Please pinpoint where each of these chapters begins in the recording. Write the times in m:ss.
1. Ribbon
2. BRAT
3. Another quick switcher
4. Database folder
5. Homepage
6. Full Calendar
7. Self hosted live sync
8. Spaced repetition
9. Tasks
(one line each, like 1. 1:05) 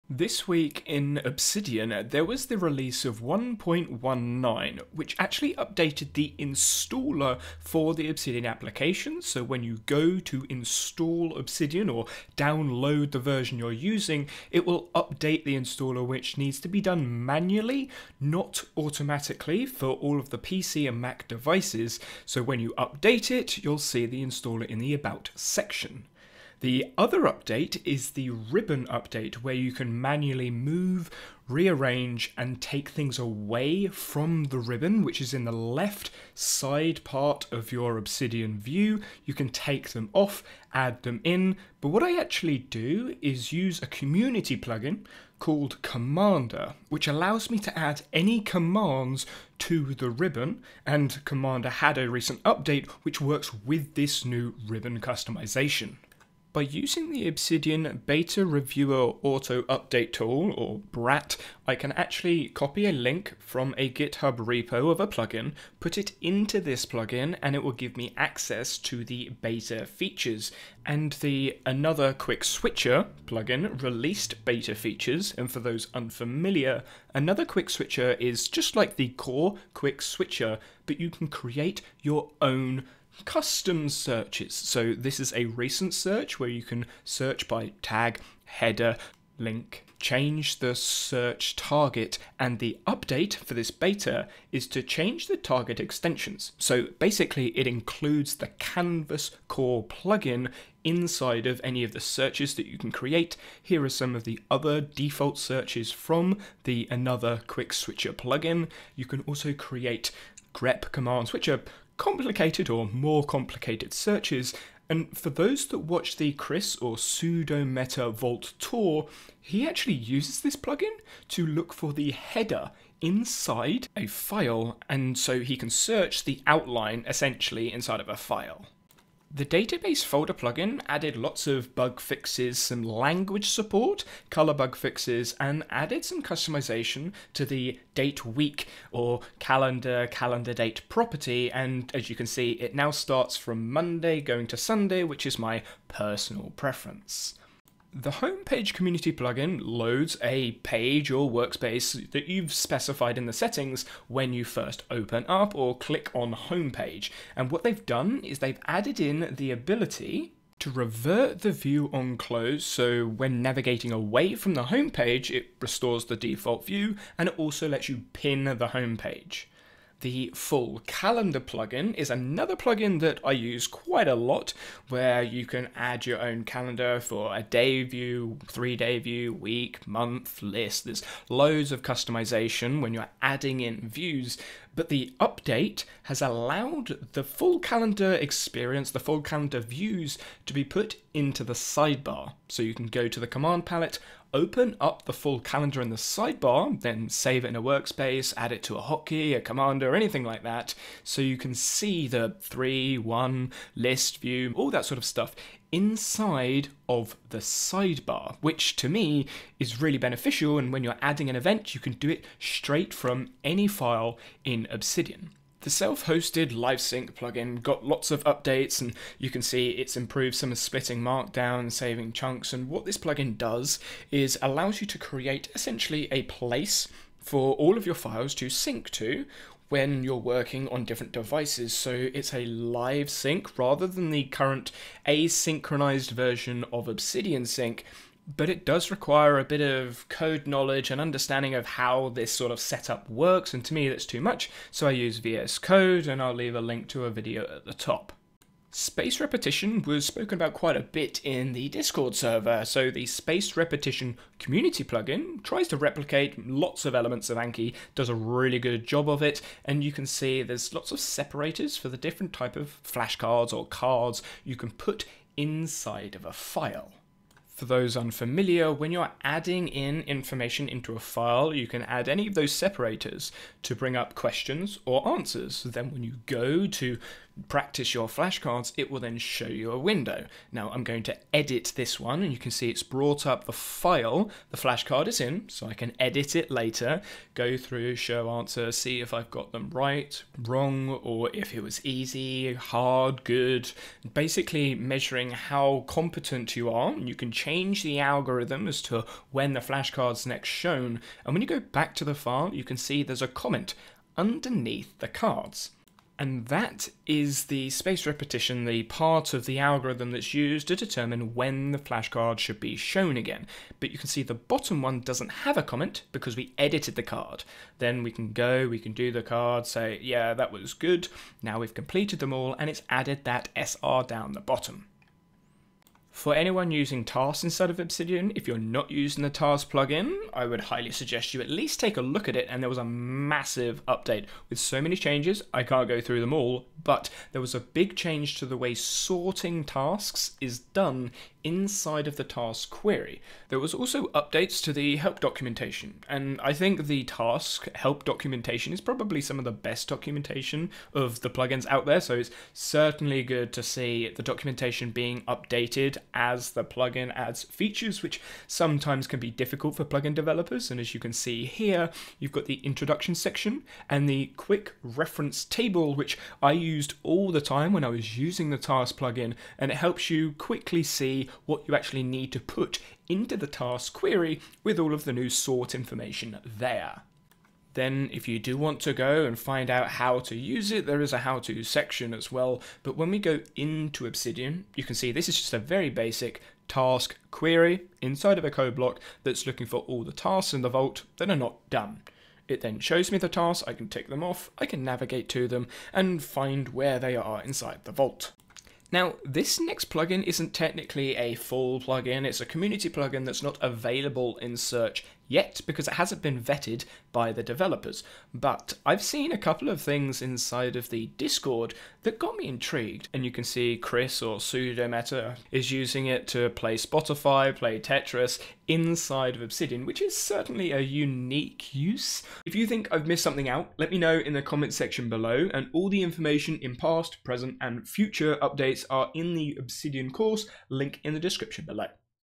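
1. 0:28
2. 0:57
3. 1:11
4. 2:10
5. 2:30
6. 2:50
7. 3:37
8. 4:11
9. 5:25.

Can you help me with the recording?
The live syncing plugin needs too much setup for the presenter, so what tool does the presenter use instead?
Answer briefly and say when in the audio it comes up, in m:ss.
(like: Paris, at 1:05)
VS Code, at 4:05.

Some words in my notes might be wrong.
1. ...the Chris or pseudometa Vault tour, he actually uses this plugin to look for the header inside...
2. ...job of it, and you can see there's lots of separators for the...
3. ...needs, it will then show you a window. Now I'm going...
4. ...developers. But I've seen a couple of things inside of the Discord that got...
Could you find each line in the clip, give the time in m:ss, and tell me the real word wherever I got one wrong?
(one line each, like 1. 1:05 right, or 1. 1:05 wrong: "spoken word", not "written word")
1. 1:56 right
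2. 4:18 right
3. 4:38 wrong: "flashcards", not "needs"
4. 6:47 right.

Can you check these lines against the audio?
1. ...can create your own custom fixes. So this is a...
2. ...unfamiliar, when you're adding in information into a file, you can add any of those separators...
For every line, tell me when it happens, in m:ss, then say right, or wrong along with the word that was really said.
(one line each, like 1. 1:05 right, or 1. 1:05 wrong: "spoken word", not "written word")
1. 1:21 wrong: "searches", not "fixes"
2. 4:27 right.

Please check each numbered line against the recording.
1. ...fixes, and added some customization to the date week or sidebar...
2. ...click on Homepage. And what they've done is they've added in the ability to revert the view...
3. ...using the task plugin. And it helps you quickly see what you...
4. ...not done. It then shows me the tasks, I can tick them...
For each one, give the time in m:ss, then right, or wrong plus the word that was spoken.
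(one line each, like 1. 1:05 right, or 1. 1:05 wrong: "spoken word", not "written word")
1. 2:14 wrong: "calendar", not "sidebar"
2. 2:35 right
3. 6:08 right
4. 6:31 right.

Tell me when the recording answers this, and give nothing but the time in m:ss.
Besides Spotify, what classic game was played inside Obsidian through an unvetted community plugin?
6:57.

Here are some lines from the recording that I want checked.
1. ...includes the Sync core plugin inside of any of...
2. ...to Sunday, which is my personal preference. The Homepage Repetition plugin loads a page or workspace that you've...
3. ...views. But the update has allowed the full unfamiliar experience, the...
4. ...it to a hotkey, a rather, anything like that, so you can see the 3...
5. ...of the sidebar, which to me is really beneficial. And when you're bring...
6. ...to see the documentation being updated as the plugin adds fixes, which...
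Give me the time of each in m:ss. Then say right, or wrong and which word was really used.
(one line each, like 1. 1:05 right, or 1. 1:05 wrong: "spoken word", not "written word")
1. 1:37 wrong: "Canvas", not "Sync"
2. 2:24 wrong: "Community", not "Repetition"
3. 3:03 wrong: "calendar", not "unfamiliar"
4. 3:18 wrong: "commander", not "rather"
5. 3:26 wrong: "adding", not "bring"
6. 5:53 wrong: "features", not "fixes".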